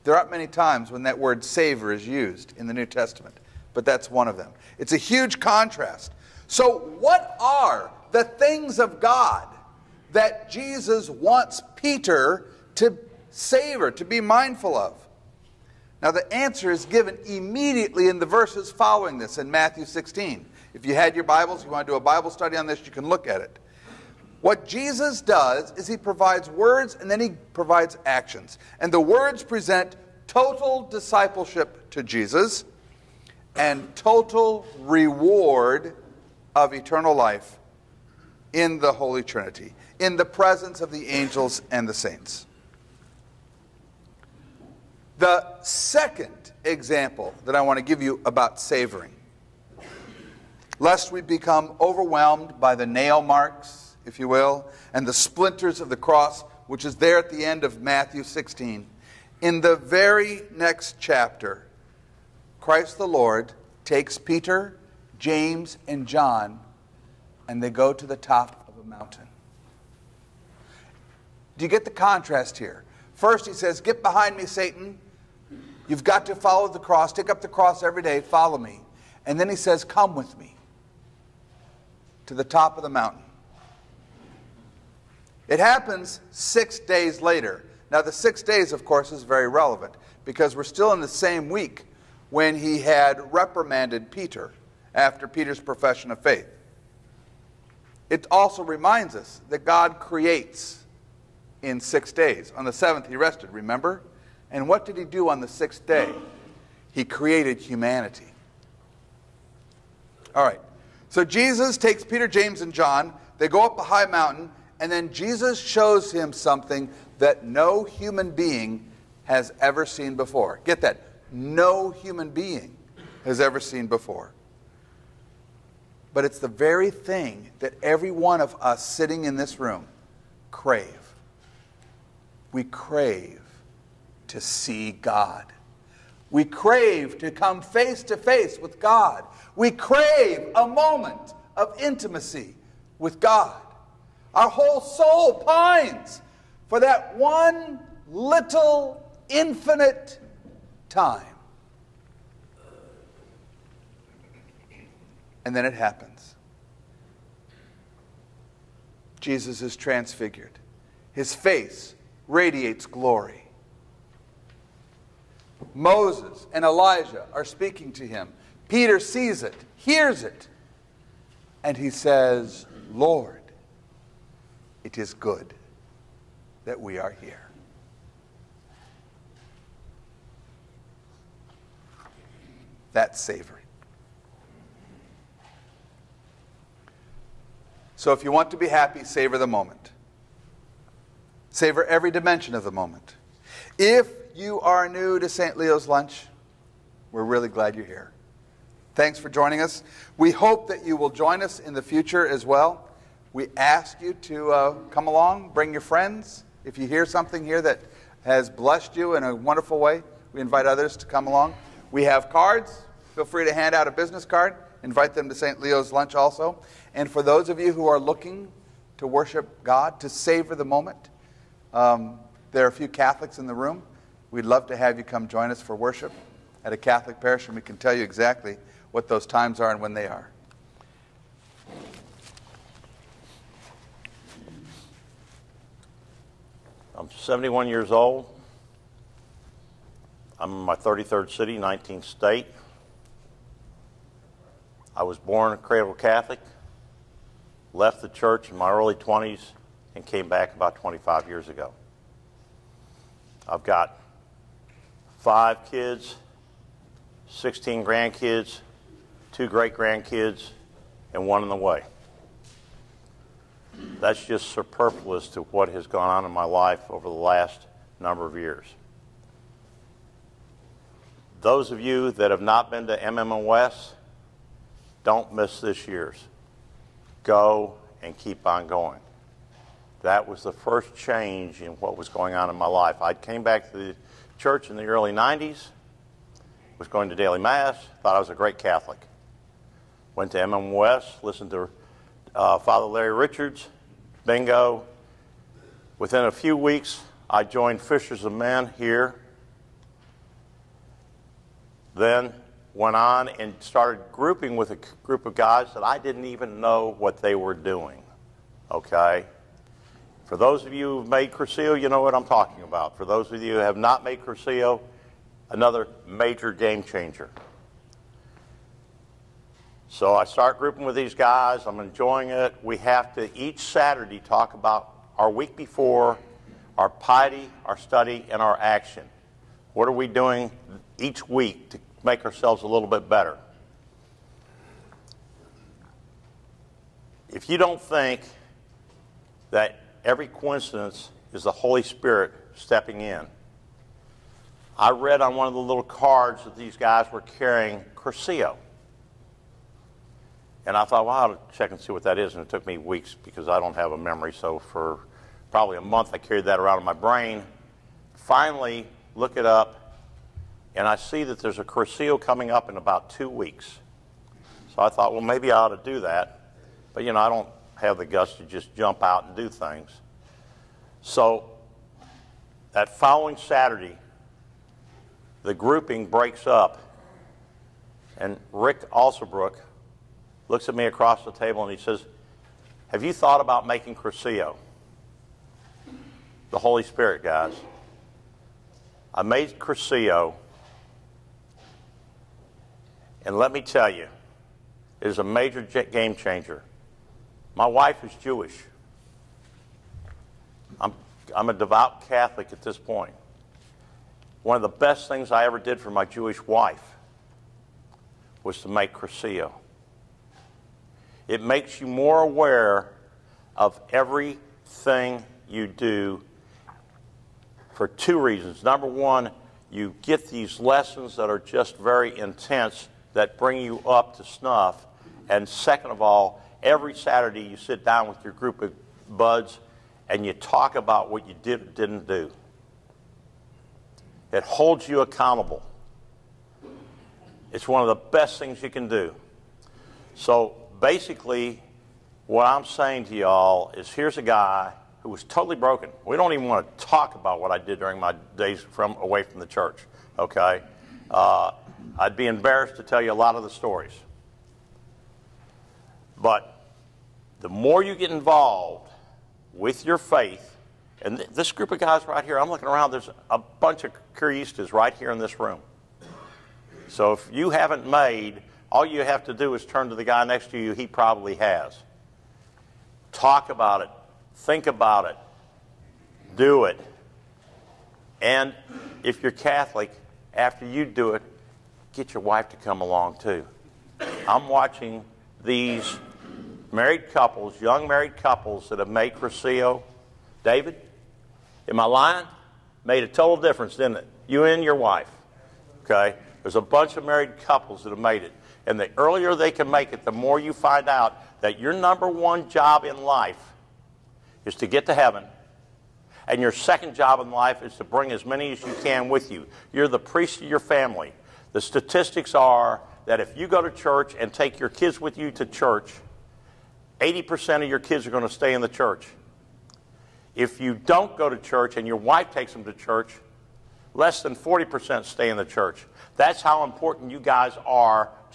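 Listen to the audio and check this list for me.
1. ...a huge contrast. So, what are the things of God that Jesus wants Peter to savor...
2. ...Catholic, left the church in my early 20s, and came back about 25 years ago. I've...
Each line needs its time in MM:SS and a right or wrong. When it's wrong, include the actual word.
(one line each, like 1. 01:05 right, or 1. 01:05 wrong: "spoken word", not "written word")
1. 00:04 right
2. 04:05 right.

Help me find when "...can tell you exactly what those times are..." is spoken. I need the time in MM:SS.
03:47.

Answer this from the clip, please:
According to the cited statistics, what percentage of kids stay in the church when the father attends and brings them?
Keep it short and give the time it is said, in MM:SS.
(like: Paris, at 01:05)
80%, at 08:36.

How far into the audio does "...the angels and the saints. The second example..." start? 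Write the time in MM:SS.
00:40.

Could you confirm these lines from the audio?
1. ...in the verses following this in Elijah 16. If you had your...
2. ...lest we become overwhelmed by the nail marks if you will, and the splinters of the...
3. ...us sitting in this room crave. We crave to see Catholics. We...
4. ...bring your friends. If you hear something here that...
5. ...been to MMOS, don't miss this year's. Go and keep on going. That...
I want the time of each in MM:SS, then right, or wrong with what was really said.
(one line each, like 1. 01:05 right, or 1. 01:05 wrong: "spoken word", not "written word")
1. 00:18 wrong: "Matthew", not "Elijah"
2. 00:50 right
3. 02:08 wrong: "God", not "Catholics"
4. 03:25 right
5. 04:32 right.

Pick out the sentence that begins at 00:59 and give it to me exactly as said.
In the very next chapter, Christ the Lord takes Peter, James, and John, and they go to the top of a mountain.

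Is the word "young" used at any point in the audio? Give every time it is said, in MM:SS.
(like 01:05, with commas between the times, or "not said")
08:07.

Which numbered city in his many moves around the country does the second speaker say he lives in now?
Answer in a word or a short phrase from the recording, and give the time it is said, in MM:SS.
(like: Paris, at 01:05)
33rd, at 04:00.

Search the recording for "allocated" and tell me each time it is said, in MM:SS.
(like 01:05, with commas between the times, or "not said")
not said.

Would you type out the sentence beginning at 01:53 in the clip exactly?
They go up a high mountain and then Jesus shows him something that no human being has ever seen before.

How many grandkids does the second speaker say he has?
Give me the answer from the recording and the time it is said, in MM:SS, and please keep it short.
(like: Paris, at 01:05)
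16, at 04:17.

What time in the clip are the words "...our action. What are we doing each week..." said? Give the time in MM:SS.
05:28.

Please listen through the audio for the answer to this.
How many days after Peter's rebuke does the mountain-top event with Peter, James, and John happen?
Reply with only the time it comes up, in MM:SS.
01:26.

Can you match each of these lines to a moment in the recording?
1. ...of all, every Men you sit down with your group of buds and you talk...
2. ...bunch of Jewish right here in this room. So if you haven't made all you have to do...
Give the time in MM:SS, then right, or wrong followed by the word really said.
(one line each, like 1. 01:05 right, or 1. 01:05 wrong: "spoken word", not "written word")
1. 07:05 wrong: "Saturday", not "Men"
2. 07:43 wrong: "Cursillistas", not "Jewish".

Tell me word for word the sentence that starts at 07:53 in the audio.
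Talk about it, think about it, do it.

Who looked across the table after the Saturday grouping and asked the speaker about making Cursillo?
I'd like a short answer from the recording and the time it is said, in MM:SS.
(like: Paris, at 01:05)
Rick Alsobrook, at 06:18.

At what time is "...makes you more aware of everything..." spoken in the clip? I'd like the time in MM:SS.
06:51.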